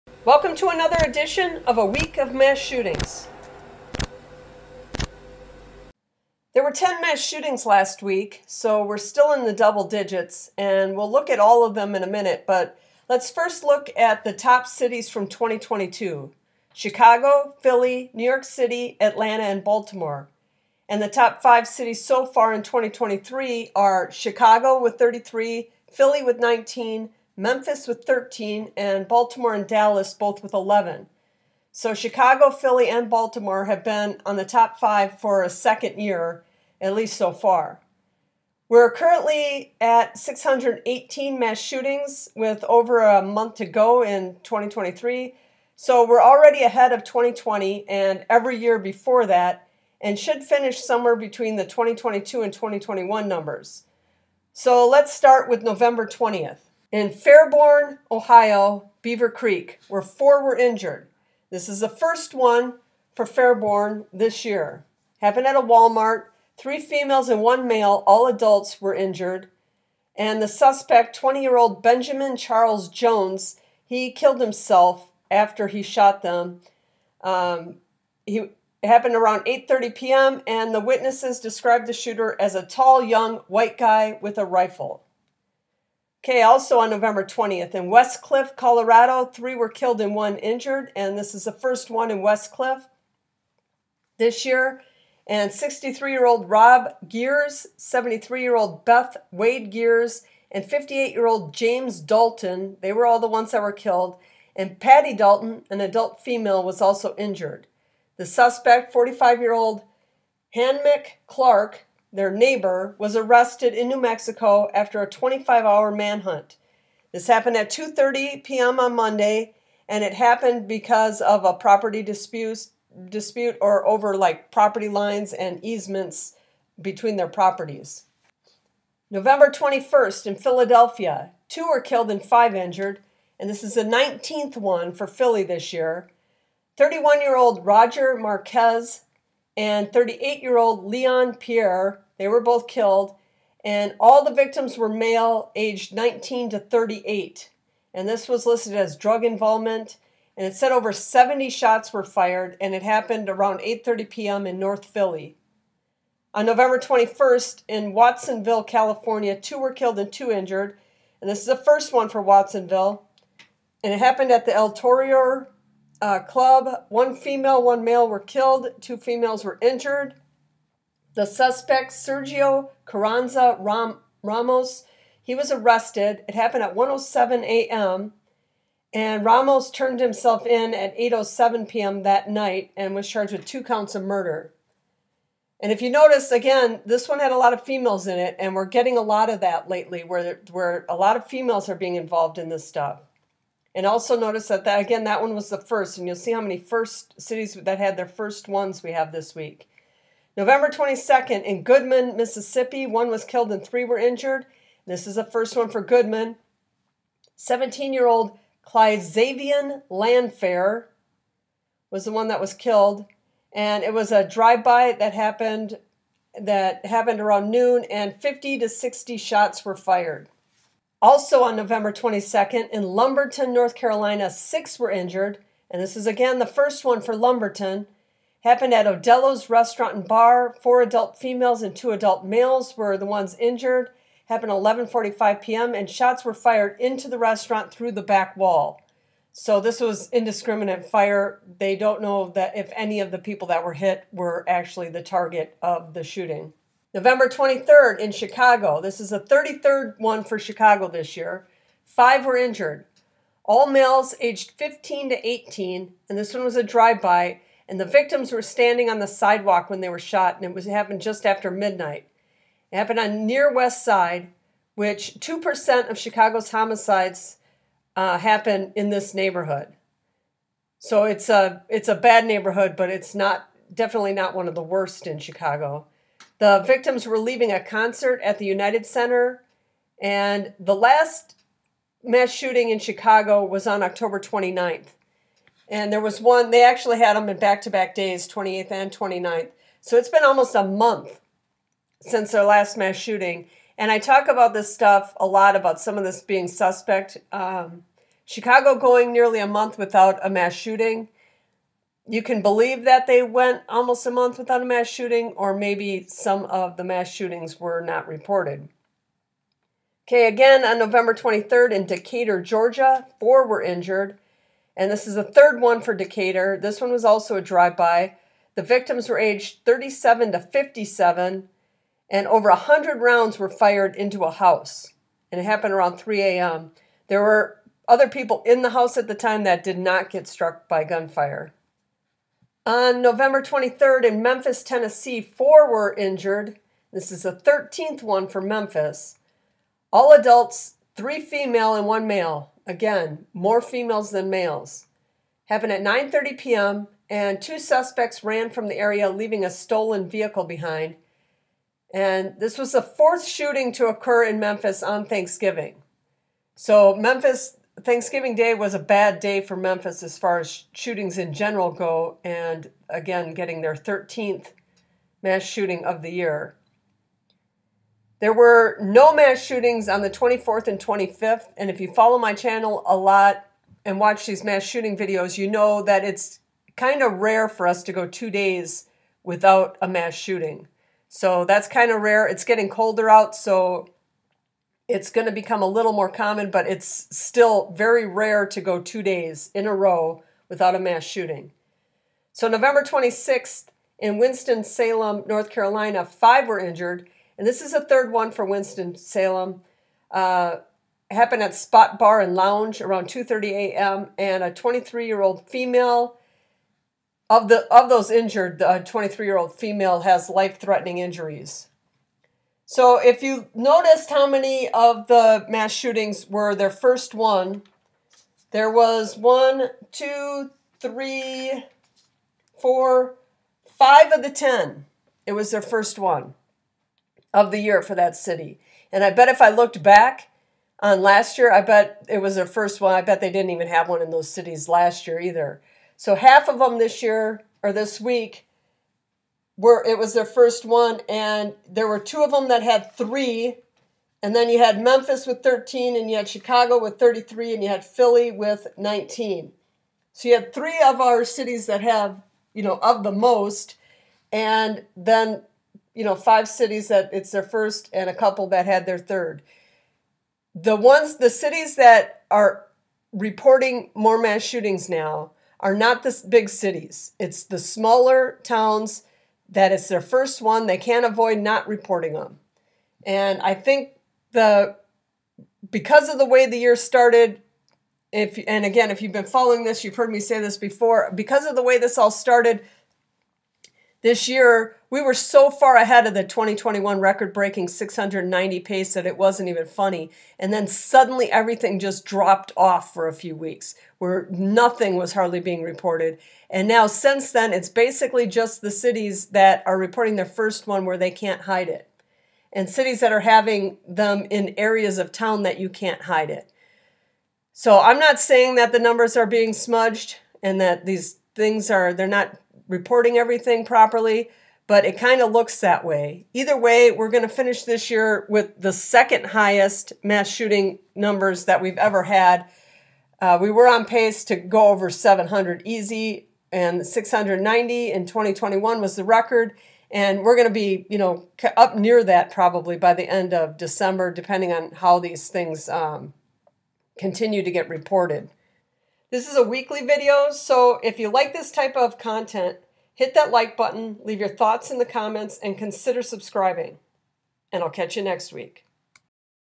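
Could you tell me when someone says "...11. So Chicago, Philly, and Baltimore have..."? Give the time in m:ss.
0:30.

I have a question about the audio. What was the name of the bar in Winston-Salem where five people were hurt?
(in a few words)
Spot Bar and Lounge.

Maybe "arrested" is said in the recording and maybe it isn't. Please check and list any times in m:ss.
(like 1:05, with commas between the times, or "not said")
1:53, 2:55.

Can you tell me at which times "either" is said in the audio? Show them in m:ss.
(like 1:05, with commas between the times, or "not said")
7:15, 8:36.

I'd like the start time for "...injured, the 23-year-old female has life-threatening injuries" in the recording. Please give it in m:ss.
6:48.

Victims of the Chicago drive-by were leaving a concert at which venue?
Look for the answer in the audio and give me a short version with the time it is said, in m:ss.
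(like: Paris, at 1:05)
United Center, at 4:38.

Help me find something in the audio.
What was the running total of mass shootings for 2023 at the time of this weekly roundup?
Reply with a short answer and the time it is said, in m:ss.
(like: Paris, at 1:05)
618, at 0:40.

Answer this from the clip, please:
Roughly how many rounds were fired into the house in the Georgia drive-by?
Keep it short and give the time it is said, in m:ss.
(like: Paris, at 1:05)
over 100, at 5:22.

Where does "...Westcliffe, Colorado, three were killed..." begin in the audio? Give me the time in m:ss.
1:27.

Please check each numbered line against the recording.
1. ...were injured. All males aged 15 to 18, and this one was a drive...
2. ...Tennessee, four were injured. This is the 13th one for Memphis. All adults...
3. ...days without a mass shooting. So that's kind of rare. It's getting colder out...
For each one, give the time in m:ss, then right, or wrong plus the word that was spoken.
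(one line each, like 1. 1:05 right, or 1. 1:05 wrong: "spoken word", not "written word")
1. 4:12 right
2. 5:34 right
3. 6:18 right.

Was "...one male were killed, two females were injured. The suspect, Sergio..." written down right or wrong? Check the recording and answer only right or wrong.
right.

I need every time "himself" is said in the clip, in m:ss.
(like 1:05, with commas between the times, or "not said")
1:14, 2:59.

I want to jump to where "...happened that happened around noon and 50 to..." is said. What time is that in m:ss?
3:35.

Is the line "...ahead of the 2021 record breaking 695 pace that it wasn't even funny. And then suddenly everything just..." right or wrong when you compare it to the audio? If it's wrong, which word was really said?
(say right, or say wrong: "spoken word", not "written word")
wrong: "690", not "695".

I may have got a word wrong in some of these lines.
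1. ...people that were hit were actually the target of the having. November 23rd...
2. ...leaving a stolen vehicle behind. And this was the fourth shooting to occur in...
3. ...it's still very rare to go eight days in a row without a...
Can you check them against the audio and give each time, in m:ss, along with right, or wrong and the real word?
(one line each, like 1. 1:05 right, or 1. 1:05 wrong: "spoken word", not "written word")
1. 4:03 wrong: "shooting", not "having"
2. 5:49 right
3. 6:26 wrong: "two", not "eight".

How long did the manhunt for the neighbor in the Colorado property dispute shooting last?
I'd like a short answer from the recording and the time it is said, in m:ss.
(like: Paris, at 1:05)
25 hours, at 1:55.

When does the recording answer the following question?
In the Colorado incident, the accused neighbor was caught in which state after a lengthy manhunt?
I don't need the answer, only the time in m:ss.
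1:53.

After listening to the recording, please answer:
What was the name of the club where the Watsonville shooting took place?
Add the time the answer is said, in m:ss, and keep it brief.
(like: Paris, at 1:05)
El Torero, at 2:44.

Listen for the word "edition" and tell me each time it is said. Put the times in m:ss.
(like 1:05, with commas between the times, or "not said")
0:01.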